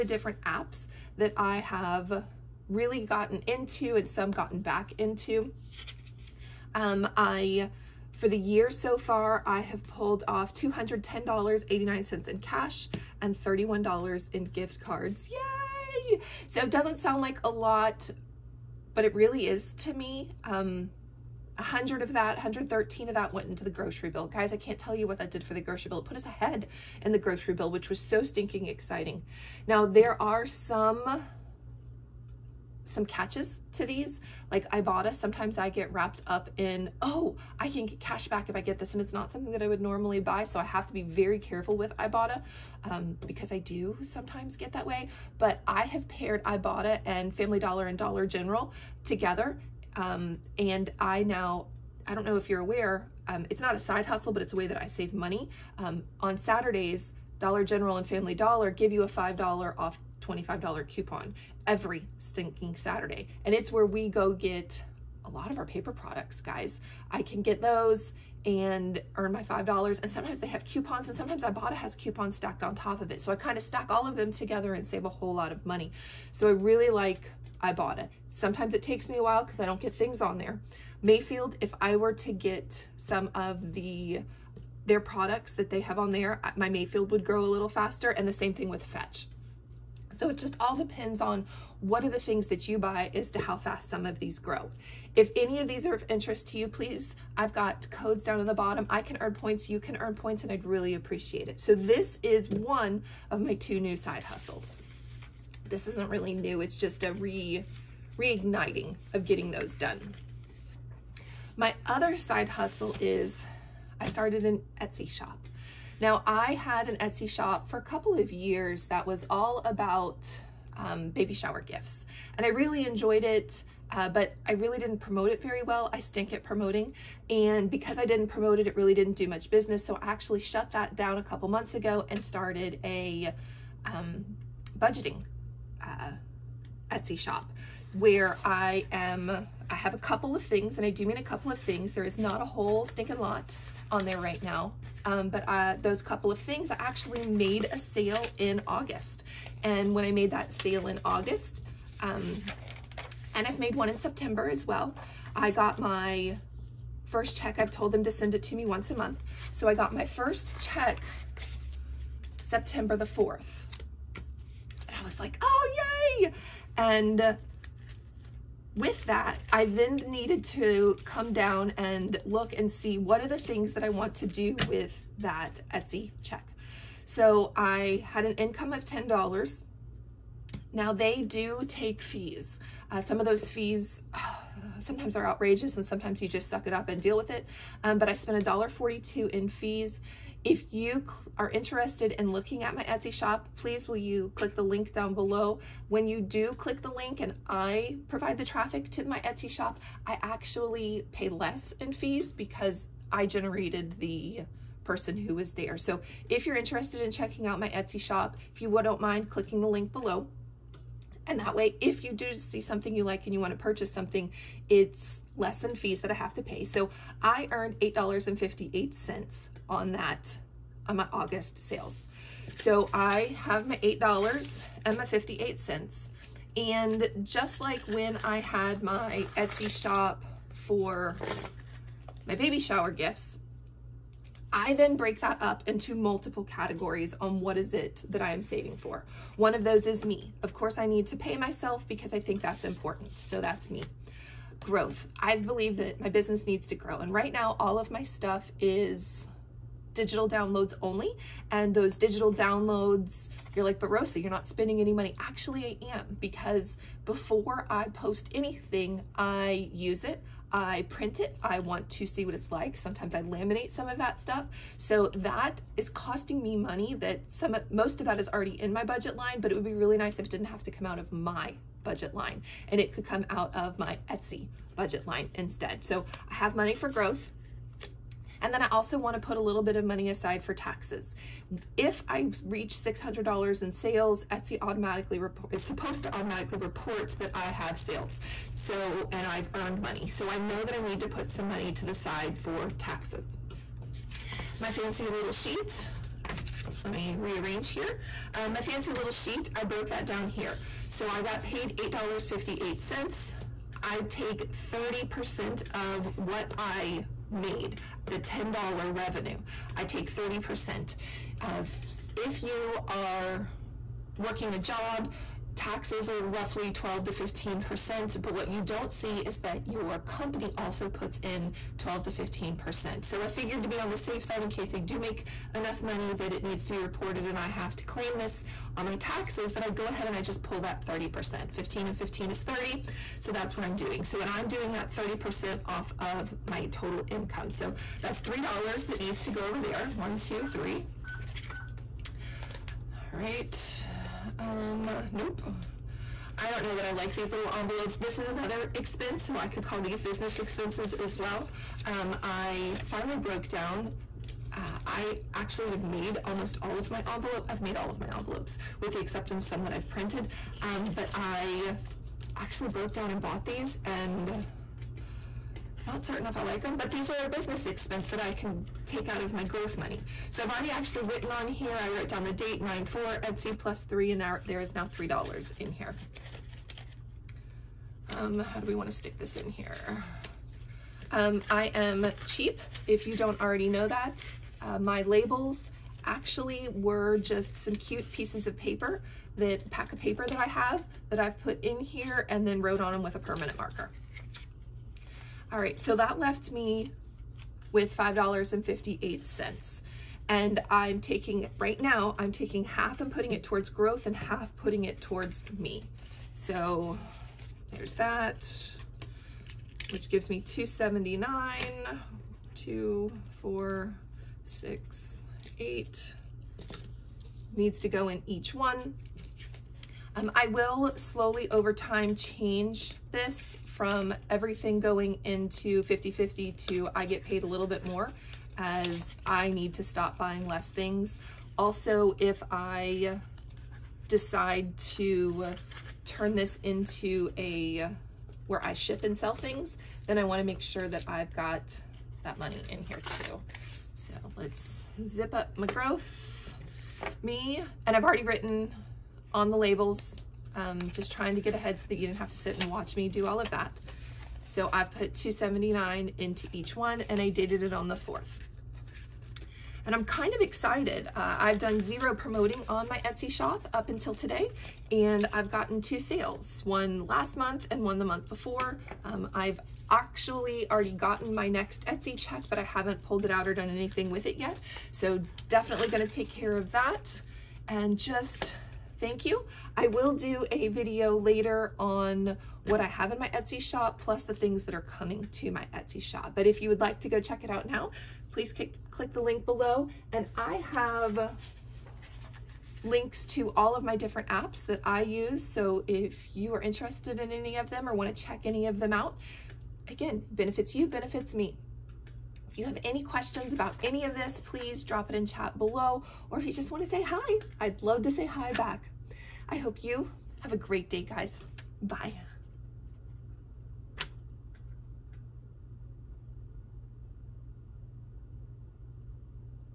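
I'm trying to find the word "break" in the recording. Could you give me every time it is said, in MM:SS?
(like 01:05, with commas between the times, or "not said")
03:54.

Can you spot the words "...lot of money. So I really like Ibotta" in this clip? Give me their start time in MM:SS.
01:15.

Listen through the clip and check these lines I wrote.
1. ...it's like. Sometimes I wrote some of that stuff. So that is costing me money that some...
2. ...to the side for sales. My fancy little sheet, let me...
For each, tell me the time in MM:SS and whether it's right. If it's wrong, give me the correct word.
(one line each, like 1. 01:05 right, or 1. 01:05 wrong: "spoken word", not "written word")
1. 04:22 wrong: "laminate", not "wrote"
2. 04:51 wrong: "taxes", not "sales".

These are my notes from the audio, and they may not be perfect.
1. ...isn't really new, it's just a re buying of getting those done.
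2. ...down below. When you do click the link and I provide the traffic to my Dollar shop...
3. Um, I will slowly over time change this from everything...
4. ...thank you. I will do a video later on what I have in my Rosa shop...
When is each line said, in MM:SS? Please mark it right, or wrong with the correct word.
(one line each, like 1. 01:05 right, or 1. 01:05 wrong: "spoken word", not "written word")
1. 01:45 wrong: "reigniting", not "buying"
2. 03:14 wrong: "Etsy", not "Dollar"
3. 07:00 right
4. 07:59 wrong: "Etsy", not "Rosa".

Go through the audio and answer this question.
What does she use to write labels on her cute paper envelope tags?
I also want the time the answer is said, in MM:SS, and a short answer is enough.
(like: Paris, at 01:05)
permanent marker, at 06:33.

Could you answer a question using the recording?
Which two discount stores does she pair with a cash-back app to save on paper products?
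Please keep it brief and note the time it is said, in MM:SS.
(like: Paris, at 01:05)
Family Dollar and Dollar General, at 00:47.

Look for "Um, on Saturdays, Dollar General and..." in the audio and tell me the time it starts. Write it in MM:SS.
00:55.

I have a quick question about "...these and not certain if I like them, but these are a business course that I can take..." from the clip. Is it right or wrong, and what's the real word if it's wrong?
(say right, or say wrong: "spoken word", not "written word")
wrong: "expense", not "course".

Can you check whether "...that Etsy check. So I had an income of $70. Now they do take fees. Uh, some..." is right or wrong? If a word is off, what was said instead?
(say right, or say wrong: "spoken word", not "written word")
wrong: "10", not "70".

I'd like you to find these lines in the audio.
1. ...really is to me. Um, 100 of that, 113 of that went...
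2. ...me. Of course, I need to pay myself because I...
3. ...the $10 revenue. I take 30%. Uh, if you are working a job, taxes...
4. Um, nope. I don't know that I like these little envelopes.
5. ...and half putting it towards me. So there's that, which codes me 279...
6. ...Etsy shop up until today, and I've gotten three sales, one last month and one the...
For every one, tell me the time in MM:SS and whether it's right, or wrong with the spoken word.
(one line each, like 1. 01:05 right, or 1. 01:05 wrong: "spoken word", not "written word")
1. 00:19 right
2. 04:00 right
3. 05:08 right
4. 05:44 right
5. 06:44 wrong: "gives", not "codes"
6. 07:43 wrong: "two", not "three".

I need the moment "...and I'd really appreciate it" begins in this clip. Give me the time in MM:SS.
01:40.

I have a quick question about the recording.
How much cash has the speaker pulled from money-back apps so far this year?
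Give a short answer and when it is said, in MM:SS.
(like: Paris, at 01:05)
$210.89, at 00:10.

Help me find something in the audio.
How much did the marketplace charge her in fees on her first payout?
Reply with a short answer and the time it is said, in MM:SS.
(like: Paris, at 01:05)
$1.42, at 03:08.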